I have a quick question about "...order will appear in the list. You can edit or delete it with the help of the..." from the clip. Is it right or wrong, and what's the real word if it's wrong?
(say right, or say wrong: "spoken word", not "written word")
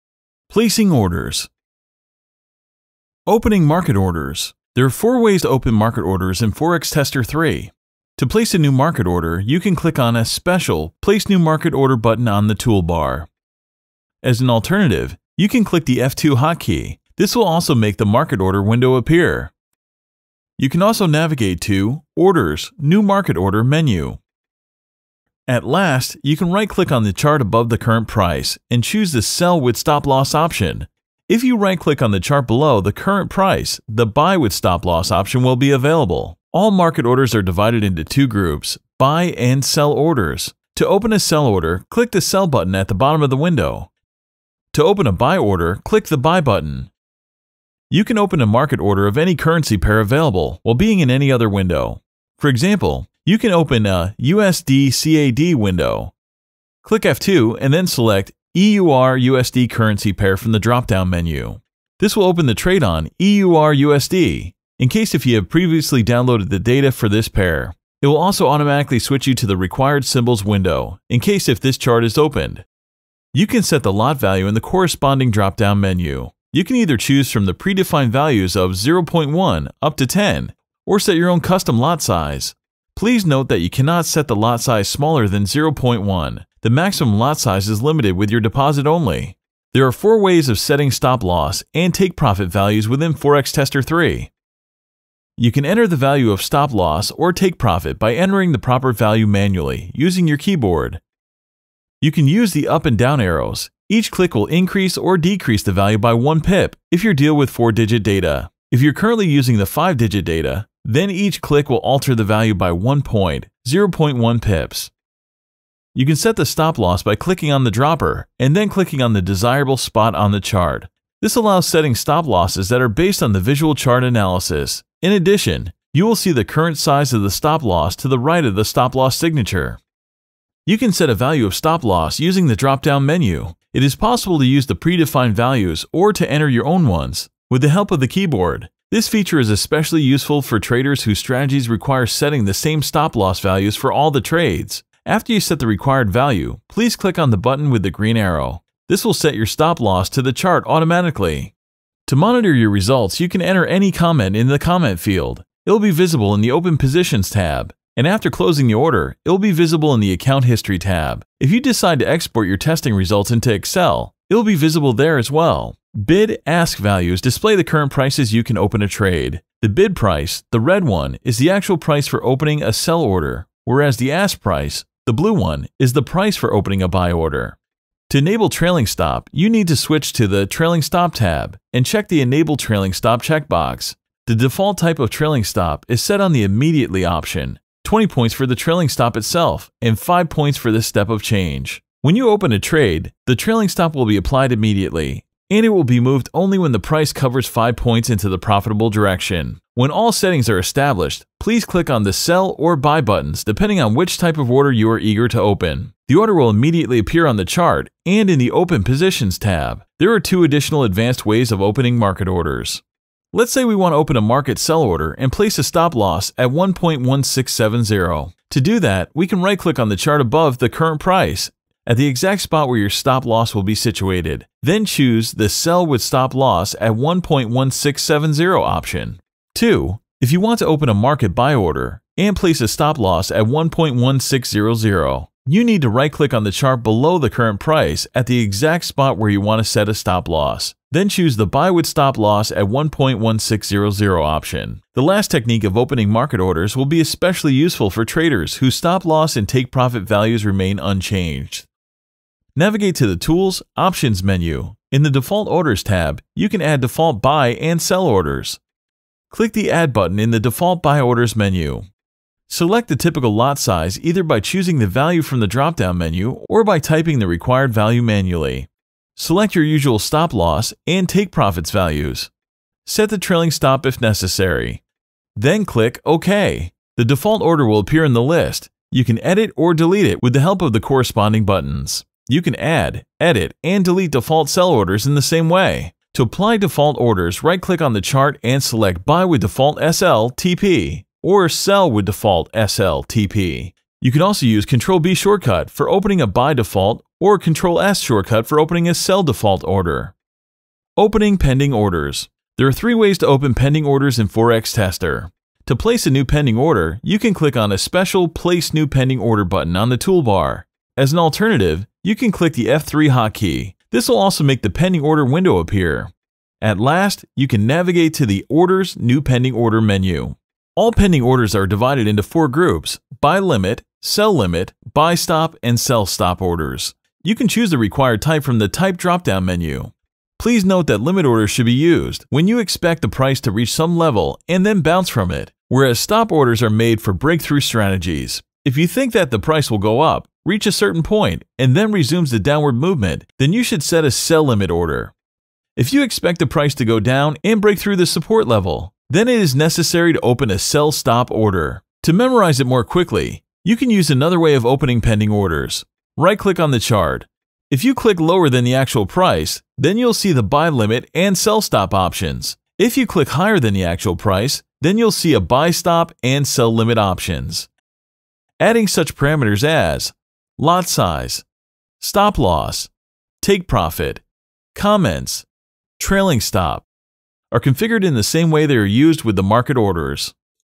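right.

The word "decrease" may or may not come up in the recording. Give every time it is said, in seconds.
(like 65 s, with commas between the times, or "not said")
105 s.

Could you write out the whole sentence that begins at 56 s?
Click F2 and then select EUR USD currency pair from the drop-down menu.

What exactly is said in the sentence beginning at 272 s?
Set the trailing stop if necessary.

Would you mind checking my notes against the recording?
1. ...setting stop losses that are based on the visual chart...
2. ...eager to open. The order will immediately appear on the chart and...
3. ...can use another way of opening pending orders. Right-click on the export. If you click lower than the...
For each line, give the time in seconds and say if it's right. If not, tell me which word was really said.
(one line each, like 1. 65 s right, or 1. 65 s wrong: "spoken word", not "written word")
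1. 121 s right
2. 204 s right
3. 353 s wrong: "chart", not "export".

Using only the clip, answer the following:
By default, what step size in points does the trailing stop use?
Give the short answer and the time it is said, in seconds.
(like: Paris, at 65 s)
5 points, at 189 s.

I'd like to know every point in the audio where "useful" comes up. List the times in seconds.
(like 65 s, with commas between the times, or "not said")
140 s, 247 s.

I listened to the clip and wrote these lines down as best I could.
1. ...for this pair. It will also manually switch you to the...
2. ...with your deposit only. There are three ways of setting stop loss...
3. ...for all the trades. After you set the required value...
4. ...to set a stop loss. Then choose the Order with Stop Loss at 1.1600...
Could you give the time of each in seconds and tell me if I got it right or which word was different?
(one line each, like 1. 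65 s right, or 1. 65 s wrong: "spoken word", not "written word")
1. 66 s wrong: "automatically", not "manually"
2. 88 s wrong: "four", not "three"
3. 143 s right
4. 239 s wrong: "Buy", not "Order".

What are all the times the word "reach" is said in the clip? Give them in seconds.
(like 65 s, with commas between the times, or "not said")
333 s, 340 s.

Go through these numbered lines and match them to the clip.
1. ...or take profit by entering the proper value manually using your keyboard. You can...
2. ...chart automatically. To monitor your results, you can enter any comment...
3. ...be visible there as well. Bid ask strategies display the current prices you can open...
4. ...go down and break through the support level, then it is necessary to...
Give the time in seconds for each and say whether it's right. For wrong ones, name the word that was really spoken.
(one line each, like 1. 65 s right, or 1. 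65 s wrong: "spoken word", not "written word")
1. 97 s right
2. 150 s right
3. 164 s wrong: "values", not "strategies"
4. 346 s right.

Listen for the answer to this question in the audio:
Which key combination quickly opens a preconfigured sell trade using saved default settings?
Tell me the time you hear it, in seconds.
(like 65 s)
297 s.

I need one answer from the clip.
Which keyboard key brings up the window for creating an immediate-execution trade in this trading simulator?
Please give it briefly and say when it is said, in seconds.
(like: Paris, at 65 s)
F2, at 15 s.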